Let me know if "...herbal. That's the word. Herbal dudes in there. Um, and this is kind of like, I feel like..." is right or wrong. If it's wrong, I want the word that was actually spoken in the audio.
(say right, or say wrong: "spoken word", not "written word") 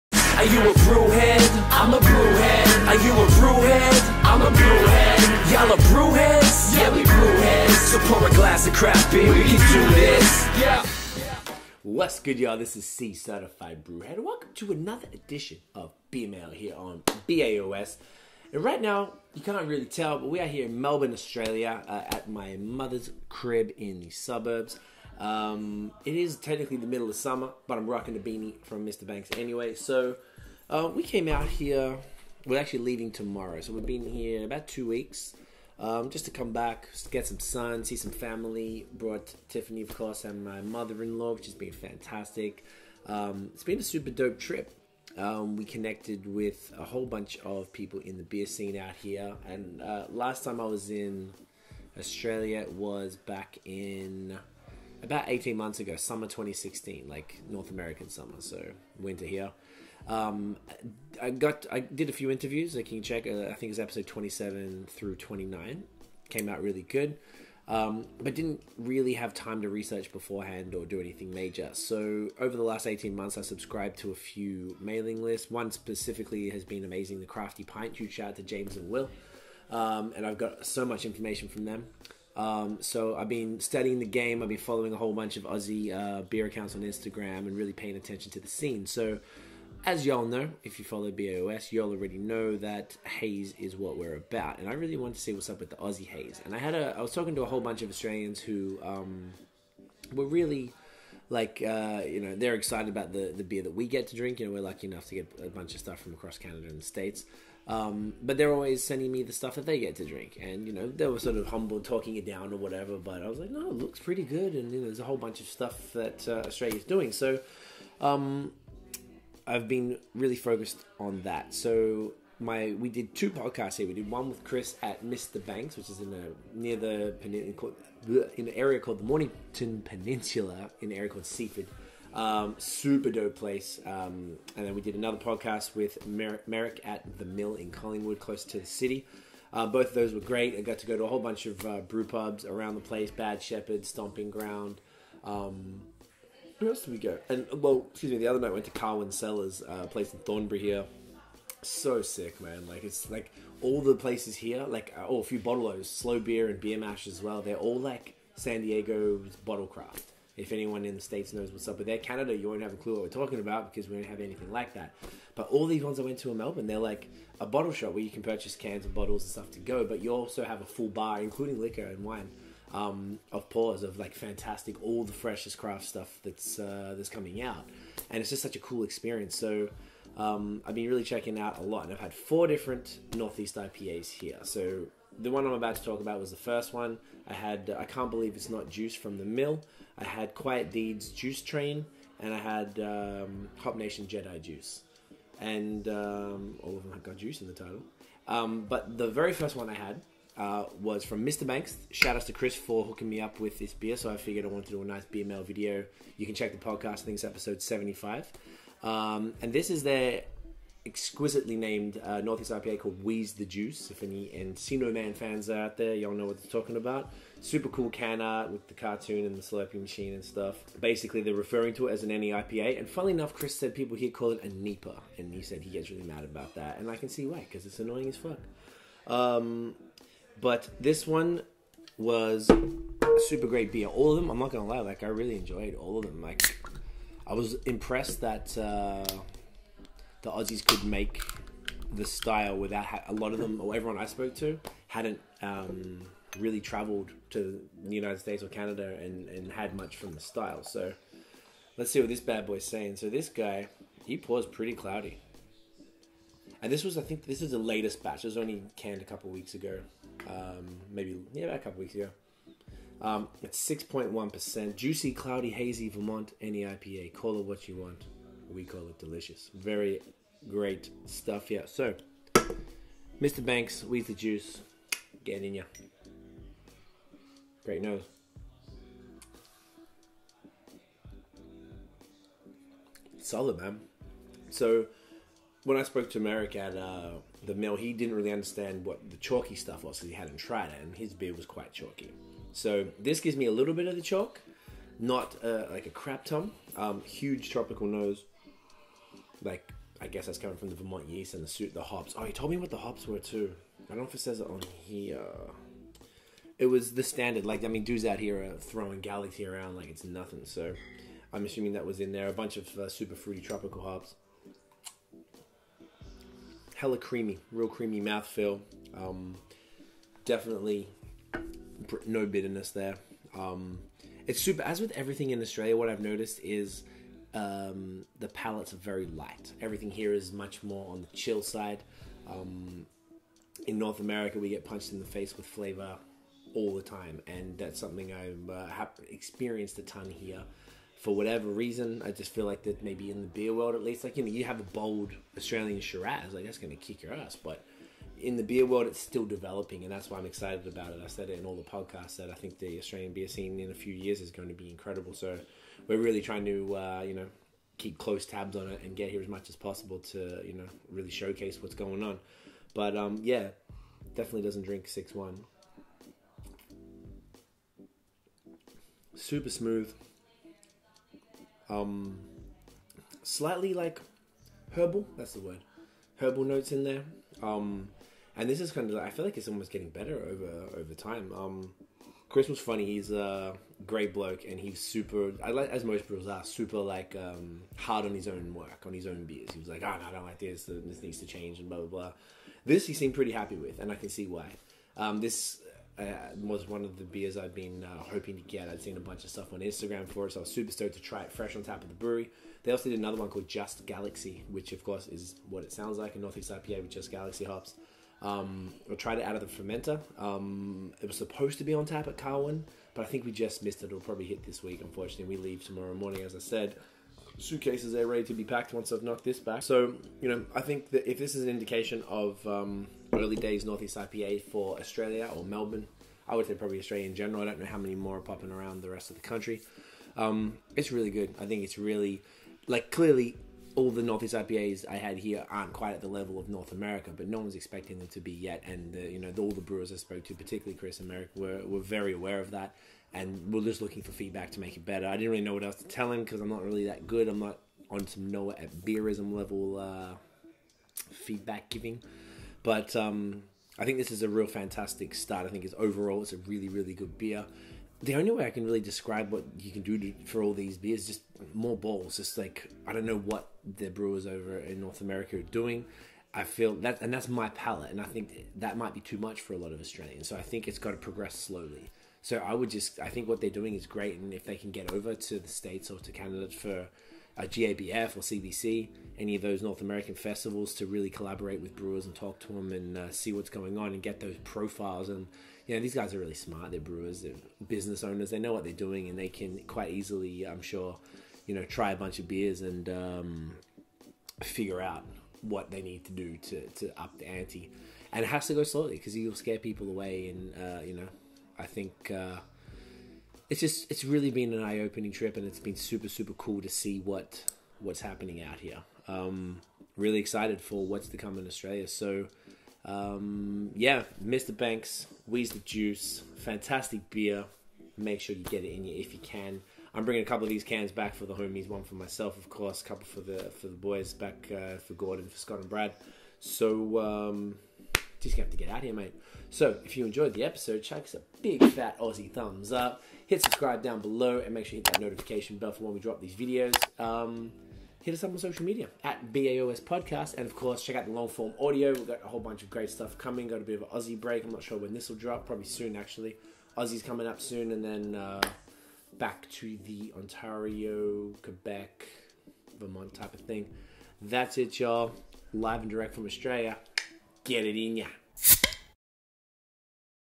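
wrong: "notes", not "dudes".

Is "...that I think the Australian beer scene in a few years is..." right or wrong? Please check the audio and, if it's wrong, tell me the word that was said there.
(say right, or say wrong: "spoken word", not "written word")
right.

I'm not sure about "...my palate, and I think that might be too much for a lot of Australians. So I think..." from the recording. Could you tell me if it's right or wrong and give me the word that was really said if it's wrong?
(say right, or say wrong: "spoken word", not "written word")
right.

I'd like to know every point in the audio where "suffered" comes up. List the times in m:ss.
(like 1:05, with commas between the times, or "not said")
not said.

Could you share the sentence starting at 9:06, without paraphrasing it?
Aussie's coming up soon, and then uh, back to the Ontario, Quebec, Vermont type of thing.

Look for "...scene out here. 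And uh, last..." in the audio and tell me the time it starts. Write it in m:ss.
0:48.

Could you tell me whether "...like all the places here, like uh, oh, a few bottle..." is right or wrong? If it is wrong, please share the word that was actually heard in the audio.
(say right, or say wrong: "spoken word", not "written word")
right.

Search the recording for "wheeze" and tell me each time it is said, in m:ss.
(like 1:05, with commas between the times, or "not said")
3:33, 8:35.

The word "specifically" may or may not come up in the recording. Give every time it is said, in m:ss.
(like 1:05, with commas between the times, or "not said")
1:15.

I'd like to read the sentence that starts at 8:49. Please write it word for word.
So if you enjoyed the episode, chuck us a big fat Aussie thumbs up.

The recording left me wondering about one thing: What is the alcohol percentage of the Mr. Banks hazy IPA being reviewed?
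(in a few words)
6.1%.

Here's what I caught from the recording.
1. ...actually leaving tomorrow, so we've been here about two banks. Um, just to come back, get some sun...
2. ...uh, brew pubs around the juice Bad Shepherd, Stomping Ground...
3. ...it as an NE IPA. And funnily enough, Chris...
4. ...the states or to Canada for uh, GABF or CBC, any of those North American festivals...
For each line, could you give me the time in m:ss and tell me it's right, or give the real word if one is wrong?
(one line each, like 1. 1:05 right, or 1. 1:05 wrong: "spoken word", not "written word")
1. 0:32 wrong: "weeks", not "banks"
2. 2:21 wrong: "place", not "juice"
3. 3:41 right
4. 7:55 right.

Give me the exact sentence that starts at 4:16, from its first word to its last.
And this was, I think, this is the latest batch.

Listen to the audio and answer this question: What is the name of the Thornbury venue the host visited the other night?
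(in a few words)
Carwyn Cellars.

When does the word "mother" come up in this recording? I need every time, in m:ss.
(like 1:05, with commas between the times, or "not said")
0:22, 0:40.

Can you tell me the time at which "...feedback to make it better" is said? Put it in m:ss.
7:24.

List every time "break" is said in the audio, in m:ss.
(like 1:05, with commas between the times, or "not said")
9:04.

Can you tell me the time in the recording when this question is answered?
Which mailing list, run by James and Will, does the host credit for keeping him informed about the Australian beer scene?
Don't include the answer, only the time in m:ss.
1:17.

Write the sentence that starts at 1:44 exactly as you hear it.
You know, we're lucky enough to get a bunch of stuff from across Canada and the States.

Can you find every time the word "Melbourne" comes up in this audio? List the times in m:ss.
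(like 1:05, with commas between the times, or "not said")
0:20, 2:46, 7:05.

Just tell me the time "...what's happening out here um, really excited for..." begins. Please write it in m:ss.
8:27.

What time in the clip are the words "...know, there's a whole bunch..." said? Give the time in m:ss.
1:54.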